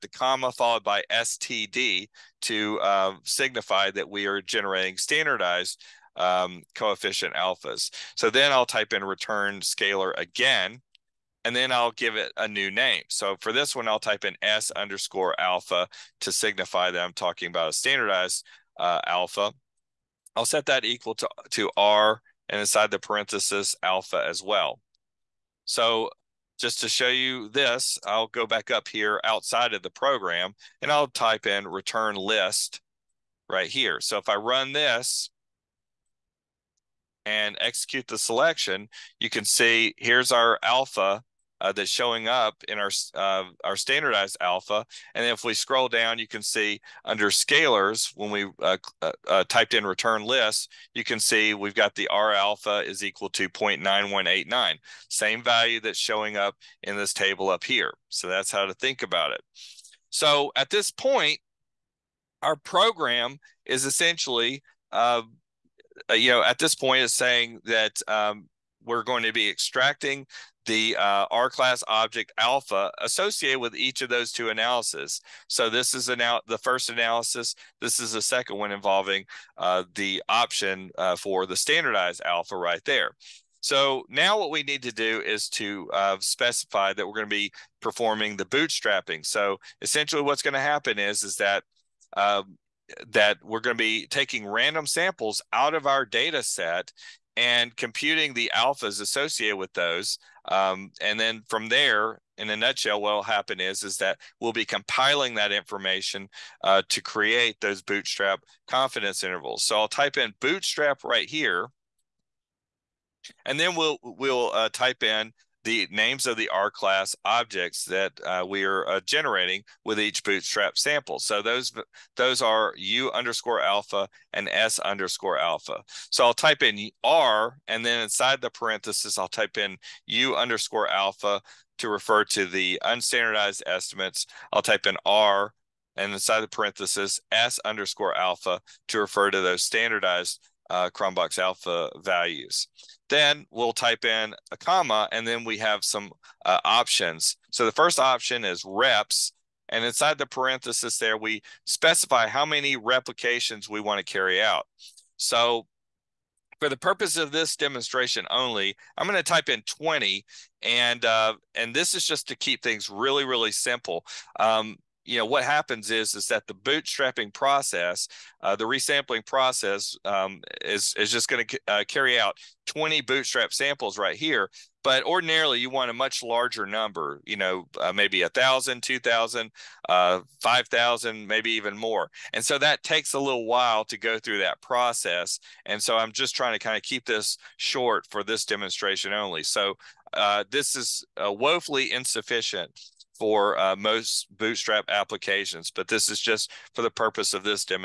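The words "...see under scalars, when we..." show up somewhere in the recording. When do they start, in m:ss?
0:46.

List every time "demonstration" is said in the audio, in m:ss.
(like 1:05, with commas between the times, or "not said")
2:37, 3:08.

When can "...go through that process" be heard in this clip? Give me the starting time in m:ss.
3:03.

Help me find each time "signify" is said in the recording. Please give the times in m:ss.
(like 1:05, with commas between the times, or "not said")
0:03, 0:16.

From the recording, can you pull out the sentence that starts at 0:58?
So that's how to think about it.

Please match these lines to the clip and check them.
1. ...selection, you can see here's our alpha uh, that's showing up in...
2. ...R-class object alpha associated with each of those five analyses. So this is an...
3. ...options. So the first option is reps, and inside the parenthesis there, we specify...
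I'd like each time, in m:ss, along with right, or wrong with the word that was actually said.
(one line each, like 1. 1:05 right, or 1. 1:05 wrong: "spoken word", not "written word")
1. 0:38 right
2. 1:11 wrong: "two", not "five"
3. 2:26 right.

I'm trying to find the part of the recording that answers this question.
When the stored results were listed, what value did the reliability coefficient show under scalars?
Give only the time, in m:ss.
0:53.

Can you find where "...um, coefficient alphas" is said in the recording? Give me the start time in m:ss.
0:06.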